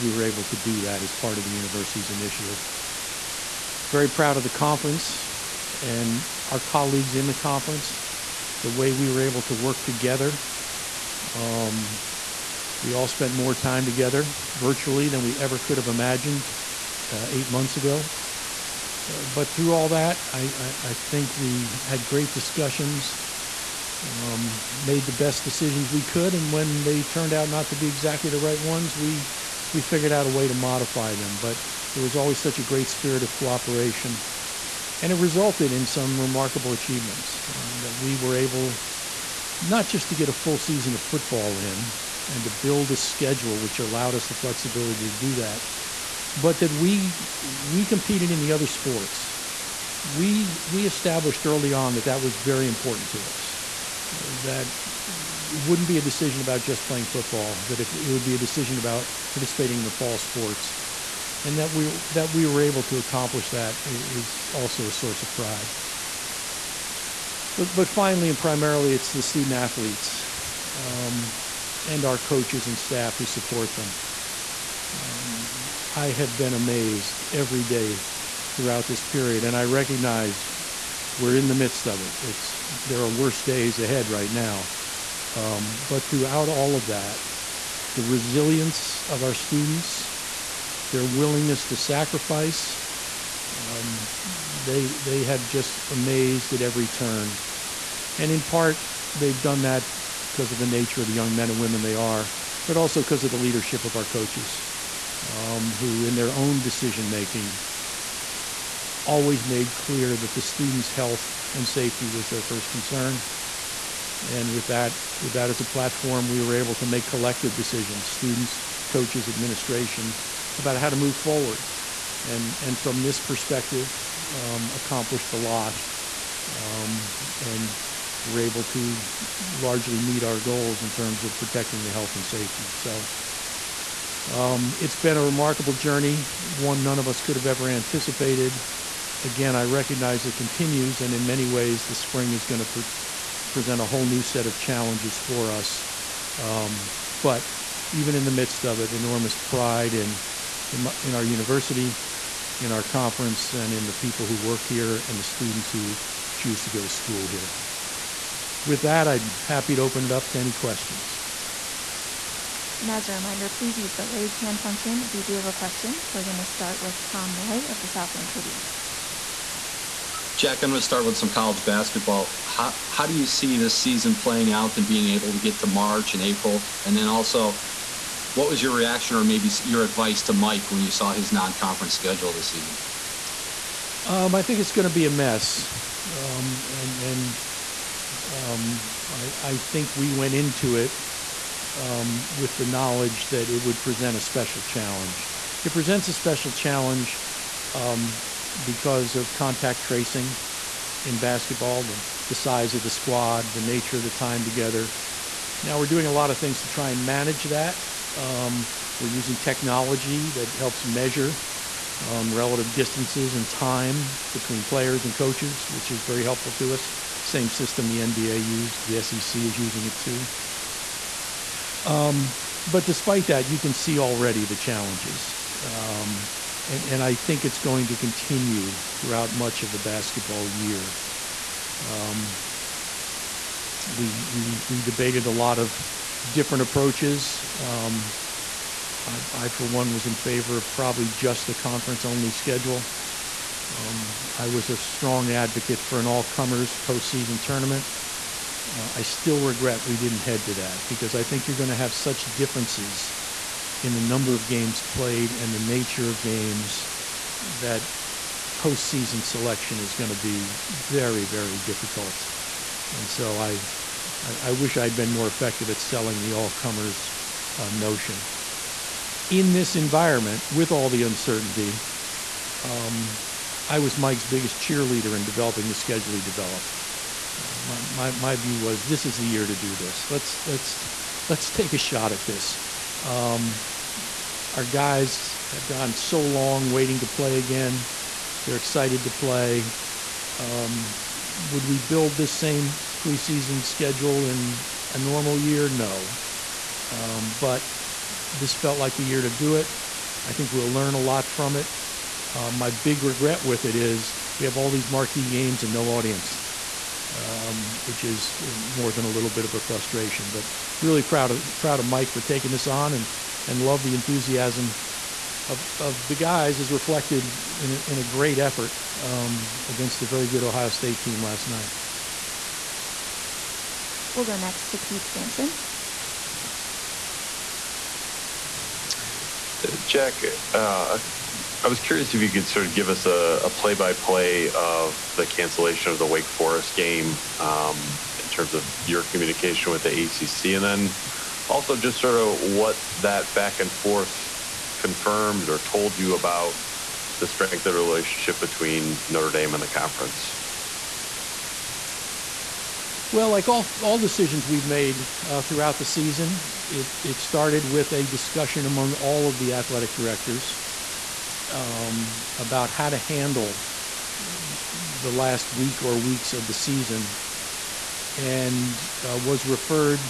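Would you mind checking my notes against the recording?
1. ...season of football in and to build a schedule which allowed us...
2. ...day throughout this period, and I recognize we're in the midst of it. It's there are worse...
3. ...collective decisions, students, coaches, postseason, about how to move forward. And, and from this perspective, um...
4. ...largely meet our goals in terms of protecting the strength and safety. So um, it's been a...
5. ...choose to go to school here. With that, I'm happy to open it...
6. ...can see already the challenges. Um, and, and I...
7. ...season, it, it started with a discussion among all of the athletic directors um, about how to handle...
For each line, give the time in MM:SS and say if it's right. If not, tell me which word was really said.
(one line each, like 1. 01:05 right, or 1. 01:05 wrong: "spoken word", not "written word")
1. 00:40 right
2. 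01:17 right
3. 01:57 wrong: "administration", not "postseason"
4. 02:09 wrong: "health", not "strength"
5. 02:36 right
6. 03:43 right
7. 05:55 right.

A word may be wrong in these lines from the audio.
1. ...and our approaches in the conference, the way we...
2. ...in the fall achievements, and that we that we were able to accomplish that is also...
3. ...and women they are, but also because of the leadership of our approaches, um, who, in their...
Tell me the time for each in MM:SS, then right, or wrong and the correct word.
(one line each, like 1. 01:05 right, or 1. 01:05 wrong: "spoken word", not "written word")
1. 00:05 wrong: "colleagues", not "approaches"
2. 00:59 wrong: "sports", not "achievements"
3. 01:41 wrong: "coaches", not "approaches".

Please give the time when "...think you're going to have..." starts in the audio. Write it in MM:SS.
04:11.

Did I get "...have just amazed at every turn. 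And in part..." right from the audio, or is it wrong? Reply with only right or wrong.
right.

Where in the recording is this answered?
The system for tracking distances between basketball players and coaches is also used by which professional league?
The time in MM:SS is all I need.
03:37.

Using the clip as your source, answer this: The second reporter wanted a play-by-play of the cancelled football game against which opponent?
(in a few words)
Wake Forest.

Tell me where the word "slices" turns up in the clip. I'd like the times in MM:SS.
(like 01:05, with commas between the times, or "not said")
not said.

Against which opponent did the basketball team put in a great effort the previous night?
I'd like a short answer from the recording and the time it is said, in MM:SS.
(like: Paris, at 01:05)
Ohio State, at 05:20.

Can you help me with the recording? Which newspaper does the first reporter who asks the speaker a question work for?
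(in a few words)
South Bend Tribune.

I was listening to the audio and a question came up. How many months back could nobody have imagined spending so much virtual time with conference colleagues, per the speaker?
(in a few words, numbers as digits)
8.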